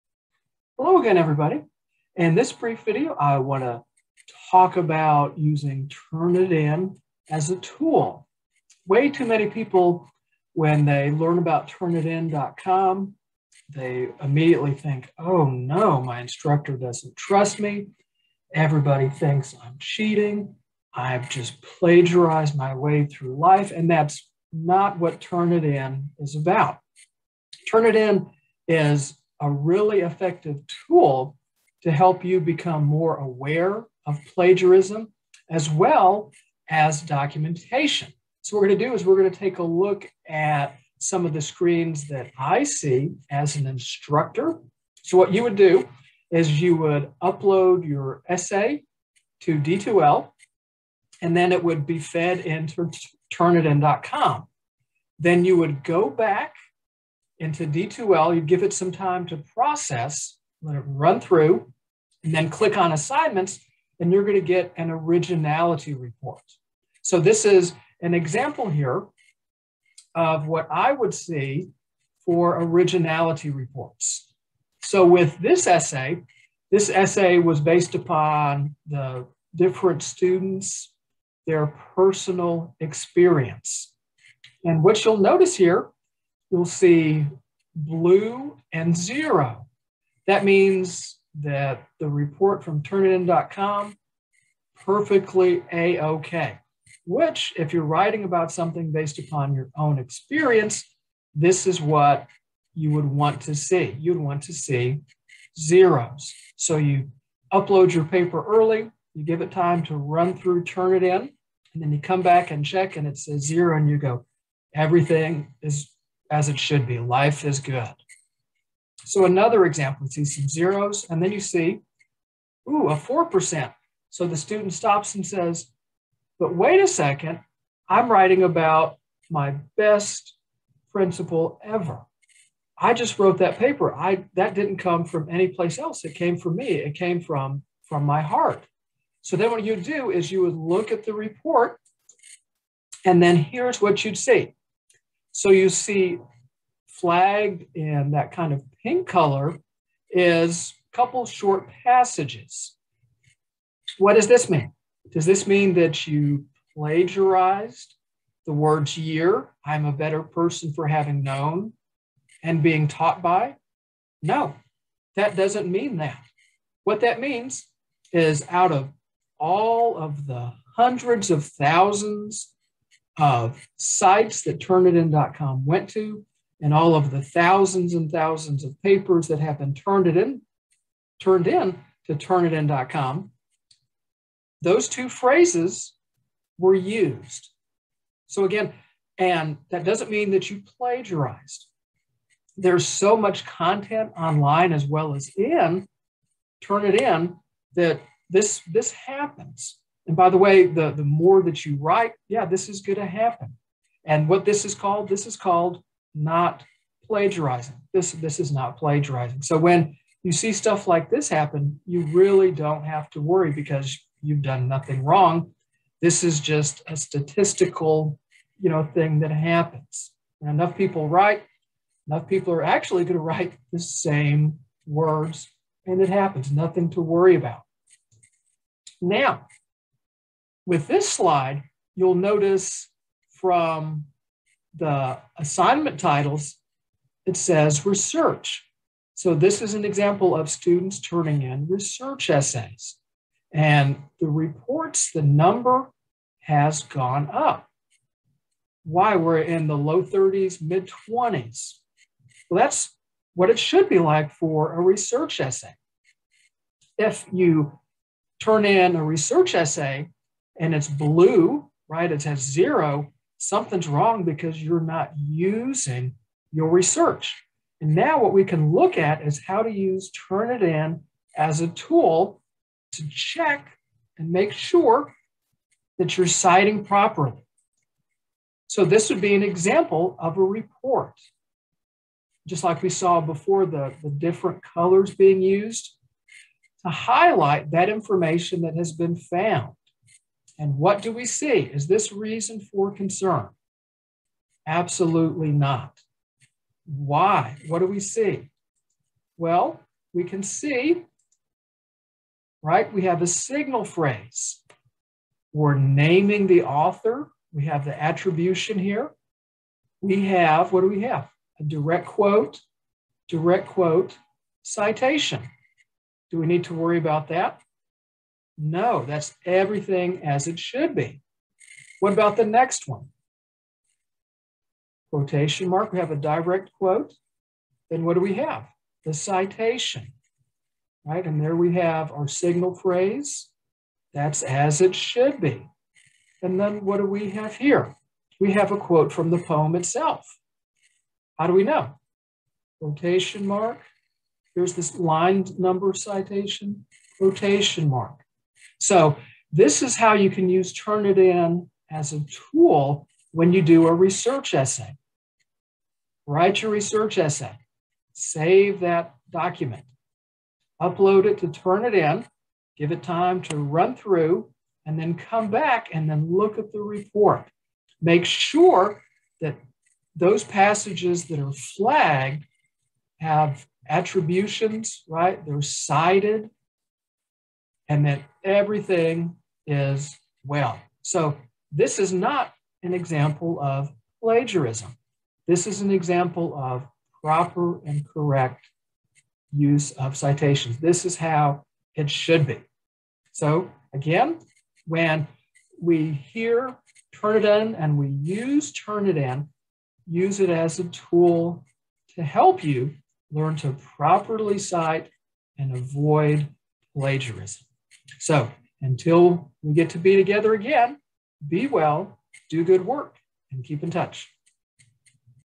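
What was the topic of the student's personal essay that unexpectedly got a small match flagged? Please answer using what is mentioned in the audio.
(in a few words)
best principal ever.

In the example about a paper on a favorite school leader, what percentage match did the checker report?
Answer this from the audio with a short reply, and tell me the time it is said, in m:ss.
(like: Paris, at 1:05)
4%, at 2:02.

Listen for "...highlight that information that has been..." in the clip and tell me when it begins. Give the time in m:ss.
4:46.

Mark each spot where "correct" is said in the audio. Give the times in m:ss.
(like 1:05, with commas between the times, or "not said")
6:28.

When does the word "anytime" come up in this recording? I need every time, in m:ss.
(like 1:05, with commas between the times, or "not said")
not said.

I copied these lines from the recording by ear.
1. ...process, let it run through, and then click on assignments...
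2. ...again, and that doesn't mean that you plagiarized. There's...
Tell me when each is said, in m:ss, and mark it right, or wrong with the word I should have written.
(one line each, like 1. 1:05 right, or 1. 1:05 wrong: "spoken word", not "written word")
1. 0:59 right
2. 3:08 right.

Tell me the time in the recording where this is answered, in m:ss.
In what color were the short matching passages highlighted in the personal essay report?
2:28.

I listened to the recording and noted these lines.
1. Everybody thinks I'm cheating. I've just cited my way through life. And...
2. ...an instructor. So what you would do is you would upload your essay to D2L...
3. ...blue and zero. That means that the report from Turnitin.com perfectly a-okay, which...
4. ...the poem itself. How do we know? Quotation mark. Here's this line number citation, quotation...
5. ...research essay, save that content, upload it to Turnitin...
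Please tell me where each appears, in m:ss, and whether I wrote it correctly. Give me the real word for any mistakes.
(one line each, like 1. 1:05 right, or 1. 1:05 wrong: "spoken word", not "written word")
1. 0:18 wrong: "plagiarized", not "cited"
2. 0:43 right
3. 1:27 right
4. 5:39 right
5. 5:56 wrong: "document", not "content".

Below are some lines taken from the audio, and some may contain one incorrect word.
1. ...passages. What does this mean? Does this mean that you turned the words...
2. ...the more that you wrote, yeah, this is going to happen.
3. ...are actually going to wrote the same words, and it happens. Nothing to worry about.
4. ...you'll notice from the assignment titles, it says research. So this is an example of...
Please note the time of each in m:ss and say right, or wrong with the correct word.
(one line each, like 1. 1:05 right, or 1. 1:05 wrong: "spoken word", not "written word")
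1. 2:31 wrong: "plagiarized", not "turned"
2. 3:20 wrong: "write", not "wrote"
3. 3:42 wrong: "write", not "wrote"
4. 3:51 right.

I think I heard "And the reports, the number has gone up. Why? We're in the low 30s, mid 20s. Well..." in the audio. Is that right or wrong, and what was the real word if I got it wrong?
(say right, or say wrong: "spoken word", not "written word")
right.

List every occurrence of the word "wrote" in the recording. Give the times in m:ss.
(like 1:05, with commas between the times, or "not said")
2:13.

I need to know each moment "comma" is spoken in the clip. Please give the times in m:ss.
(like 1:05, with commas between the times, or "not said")
not said.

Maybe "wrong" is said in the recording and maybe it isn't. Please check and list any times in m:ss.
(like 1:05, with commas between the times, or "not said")
3:35, 4:23.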